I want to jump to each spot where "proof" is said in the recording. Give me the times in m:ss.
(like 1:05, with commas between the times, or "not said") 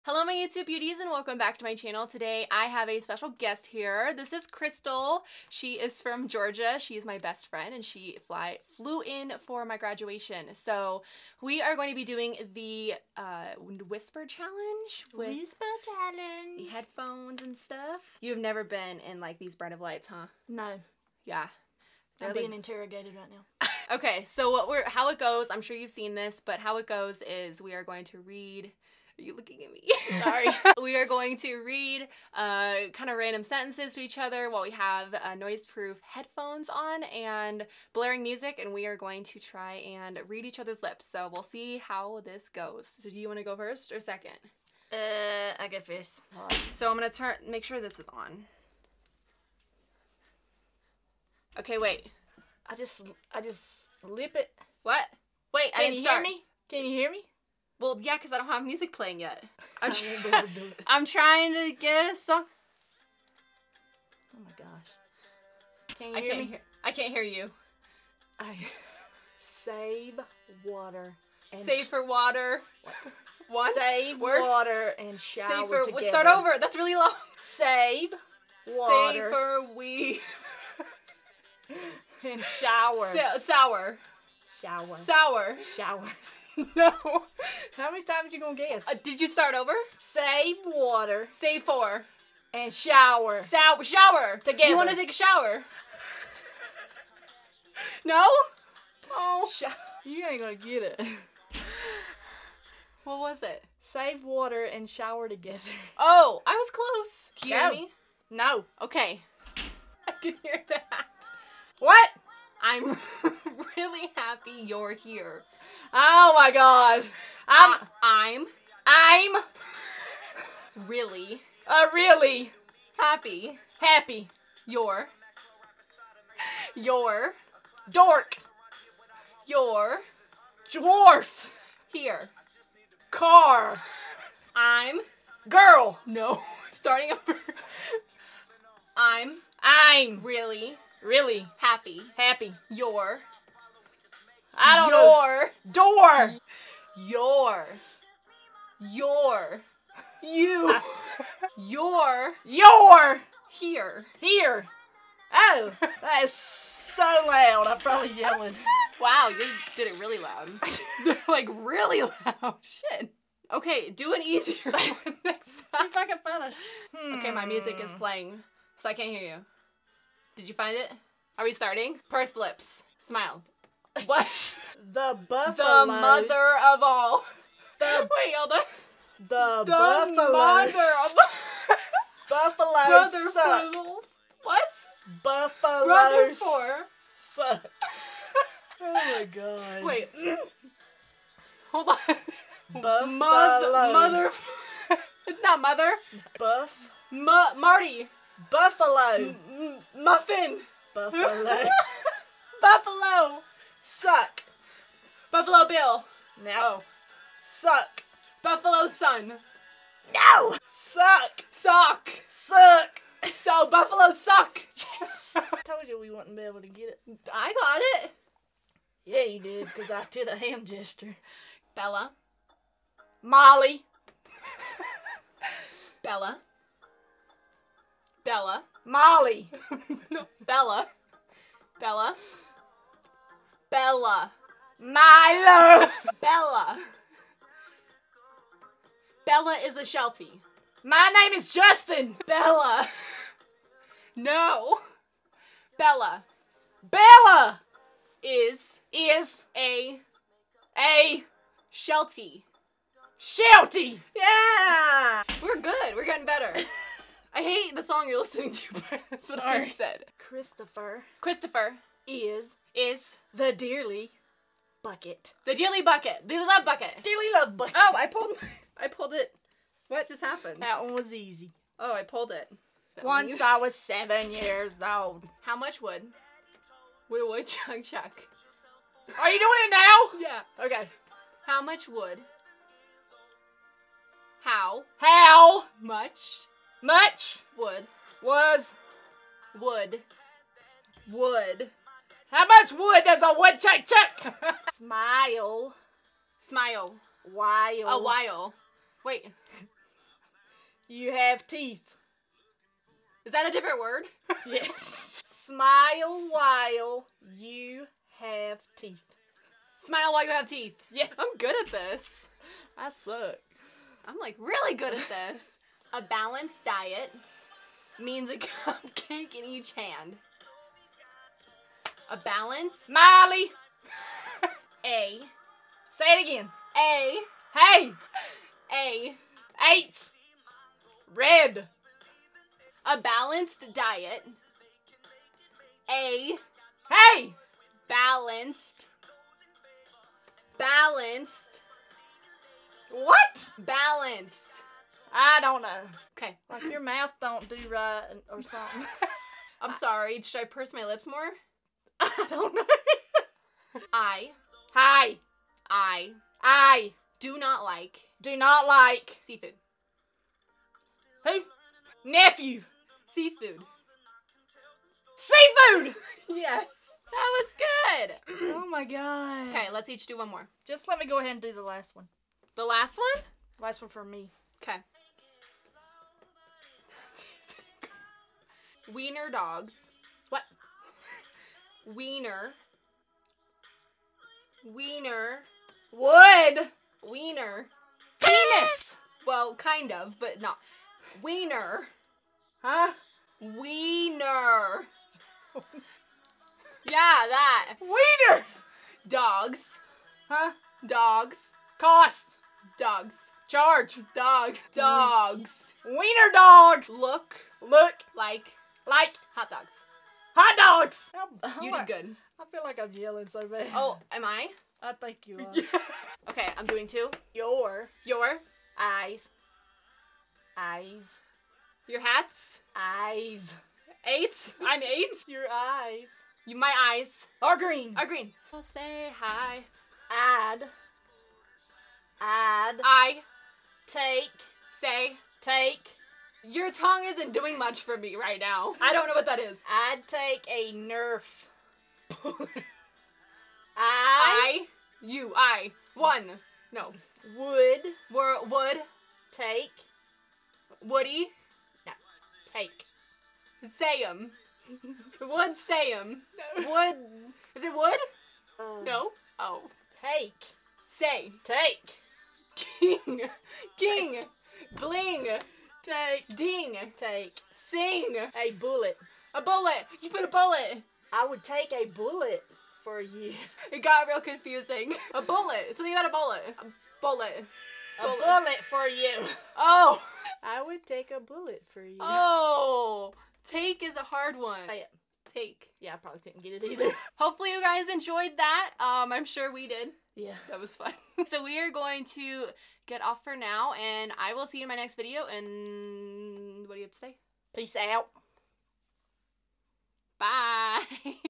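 0:35.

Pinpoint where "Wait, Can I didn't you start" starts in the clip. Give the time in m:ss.
0:55.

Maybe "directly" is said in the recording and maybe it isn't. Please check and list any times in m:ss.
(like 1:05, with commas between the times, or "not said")
not said.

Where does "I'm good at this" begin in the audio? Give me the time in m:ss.
5:11.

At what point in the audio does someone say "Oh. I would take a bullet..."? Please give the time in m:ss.
7:59.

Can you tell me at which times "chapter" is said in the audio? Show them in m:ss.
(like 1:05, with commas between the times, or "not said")
not said.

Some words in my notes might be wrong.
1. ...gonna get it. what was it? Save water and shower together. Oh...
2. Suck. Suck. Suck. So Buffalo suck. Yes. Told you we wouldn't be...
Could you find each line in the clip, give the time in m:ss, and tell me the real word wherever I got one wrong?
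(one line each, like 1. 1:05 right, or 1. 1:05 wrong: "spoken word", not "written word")
1. 1:40 right
2. 3:30 right.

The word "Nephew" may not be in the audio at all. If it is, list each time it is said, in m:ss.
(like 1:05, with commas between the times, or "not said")
6:02.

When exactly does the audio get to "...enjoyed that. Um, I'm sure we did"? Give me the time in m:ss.
8:07.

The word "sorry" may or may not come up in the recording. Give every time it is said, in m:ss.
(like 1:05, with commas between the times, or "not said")
0:30, 5:49.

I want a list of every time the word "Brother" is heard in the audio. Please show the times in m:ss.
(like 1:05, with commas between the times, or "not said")
3:05.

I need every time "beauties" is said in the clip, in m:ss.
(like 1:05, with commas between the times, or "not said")
0:00.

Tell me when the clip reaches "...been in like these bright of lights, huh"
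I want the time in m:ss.
0:18.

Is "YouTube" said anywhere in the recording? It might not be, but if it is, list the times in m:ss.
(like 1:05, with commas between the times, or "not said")
0:00.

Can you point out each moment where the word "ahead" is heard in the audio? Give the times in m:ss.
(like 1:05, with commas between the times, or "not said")
6:11.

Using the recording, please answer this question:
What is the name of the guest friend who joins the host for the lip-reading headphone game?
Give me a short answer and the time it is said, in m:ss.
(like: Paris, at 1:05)
Crystal, at 0:04.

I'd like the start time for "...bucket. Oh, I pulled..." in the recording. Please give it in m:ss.
4:27.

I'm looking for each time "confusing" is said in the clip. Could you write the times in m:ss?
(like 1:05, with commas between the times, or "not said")
7:54.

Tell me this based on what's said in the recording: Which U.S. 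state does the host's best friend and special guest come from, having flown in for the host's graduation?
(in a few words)
Georgia.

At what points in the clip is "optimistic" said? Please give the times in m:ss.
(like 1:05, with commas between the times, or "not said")
not said.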